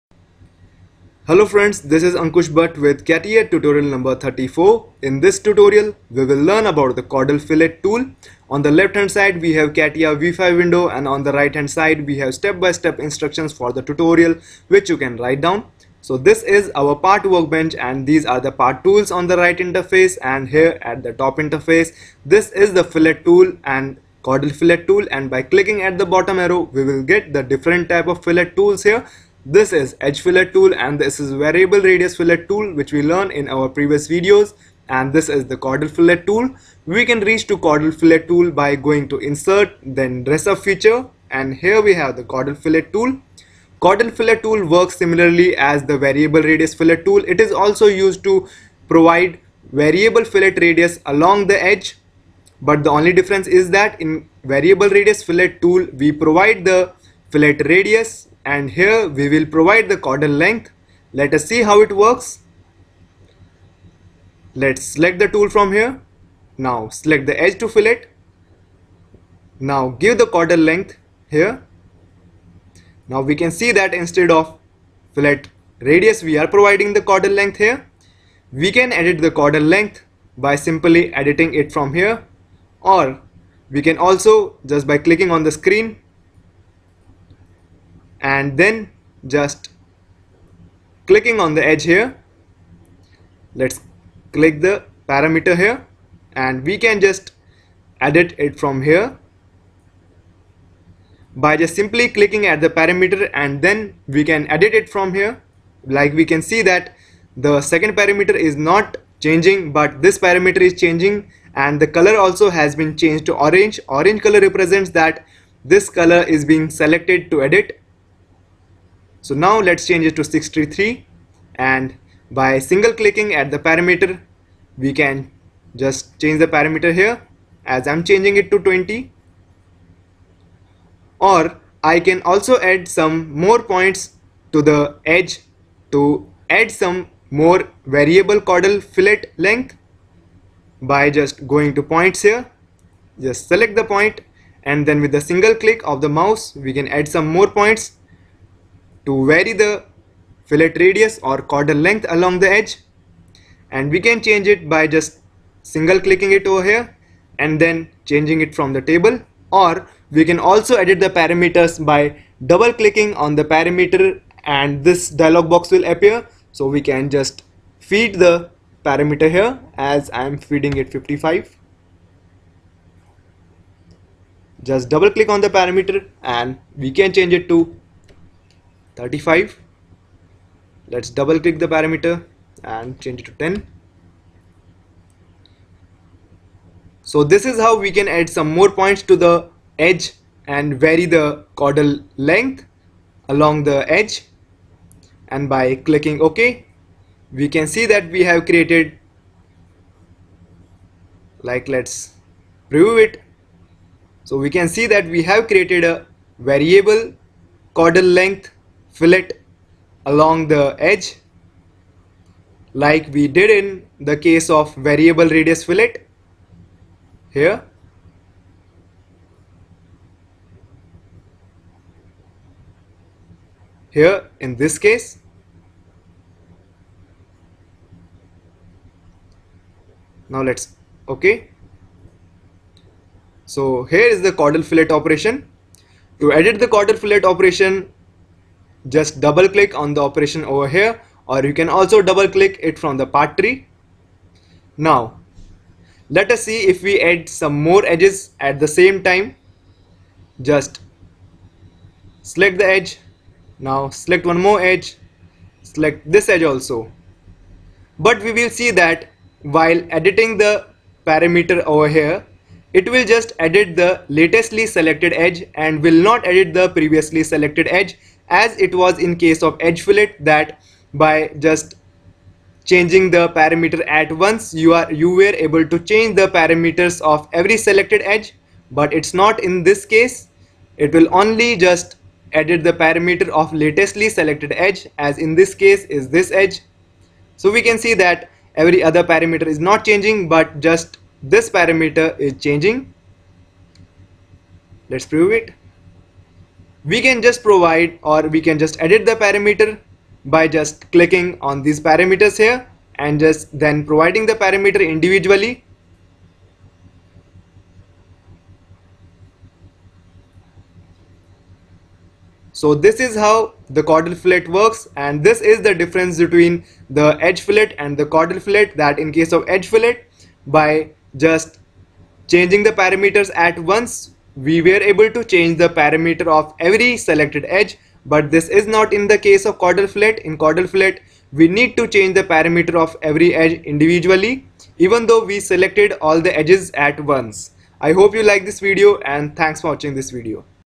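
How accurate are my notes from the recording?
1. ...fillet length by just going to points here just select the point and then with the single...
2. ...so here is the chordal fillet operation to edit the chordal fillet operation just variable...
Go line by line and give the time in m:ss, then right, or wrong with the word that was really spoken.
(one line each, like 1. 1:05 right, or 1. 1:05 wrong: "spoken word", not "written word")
1. 2:18 right
2. 3:53 wrong: "double", not "variable".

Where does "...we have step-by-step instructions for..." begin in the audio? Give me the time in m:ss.
0:12.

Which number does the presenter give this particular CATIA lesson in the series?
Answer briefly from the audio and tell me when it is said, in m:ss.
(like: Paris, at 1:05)
34, at 0:04.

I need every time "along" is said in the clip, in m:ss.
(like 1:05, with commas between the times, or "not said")
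0:51, 2:32, 3:13, 3:30.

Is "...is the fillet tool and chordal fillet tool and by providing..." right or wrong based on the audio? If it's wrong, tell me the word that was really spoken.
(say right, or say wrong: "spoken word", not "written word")
wrong: "clicking", not "providing".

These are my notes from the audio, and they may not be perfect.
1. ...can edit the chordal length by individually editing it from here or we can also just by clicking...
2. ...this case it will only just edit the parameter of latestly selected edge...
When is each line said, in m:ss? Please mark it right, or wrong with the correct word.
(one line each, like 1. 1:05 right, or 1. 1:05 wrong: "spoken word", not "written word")
1. 1:18 wrong: "simply", not "individually"
2. 4:39 right.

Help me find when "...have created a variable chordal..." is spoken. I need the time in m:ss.
3:25.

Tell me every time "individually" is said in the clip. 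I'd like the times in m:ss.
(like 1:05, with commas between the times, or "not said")
5:04, 5:33.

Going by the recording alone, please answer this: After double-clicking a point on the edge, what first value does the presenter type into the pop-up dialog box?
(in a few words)
55.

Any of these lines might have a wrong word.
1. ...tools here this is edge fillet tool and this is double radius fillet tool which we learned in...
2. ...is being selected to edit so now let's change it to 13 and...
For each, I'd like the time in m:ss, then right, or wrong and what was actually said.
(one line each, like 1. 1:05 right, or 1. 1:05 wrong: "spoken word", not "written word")
1. 0:28 wrong: "variable", not "double"
2. 1:56 wrong: "63", not "13".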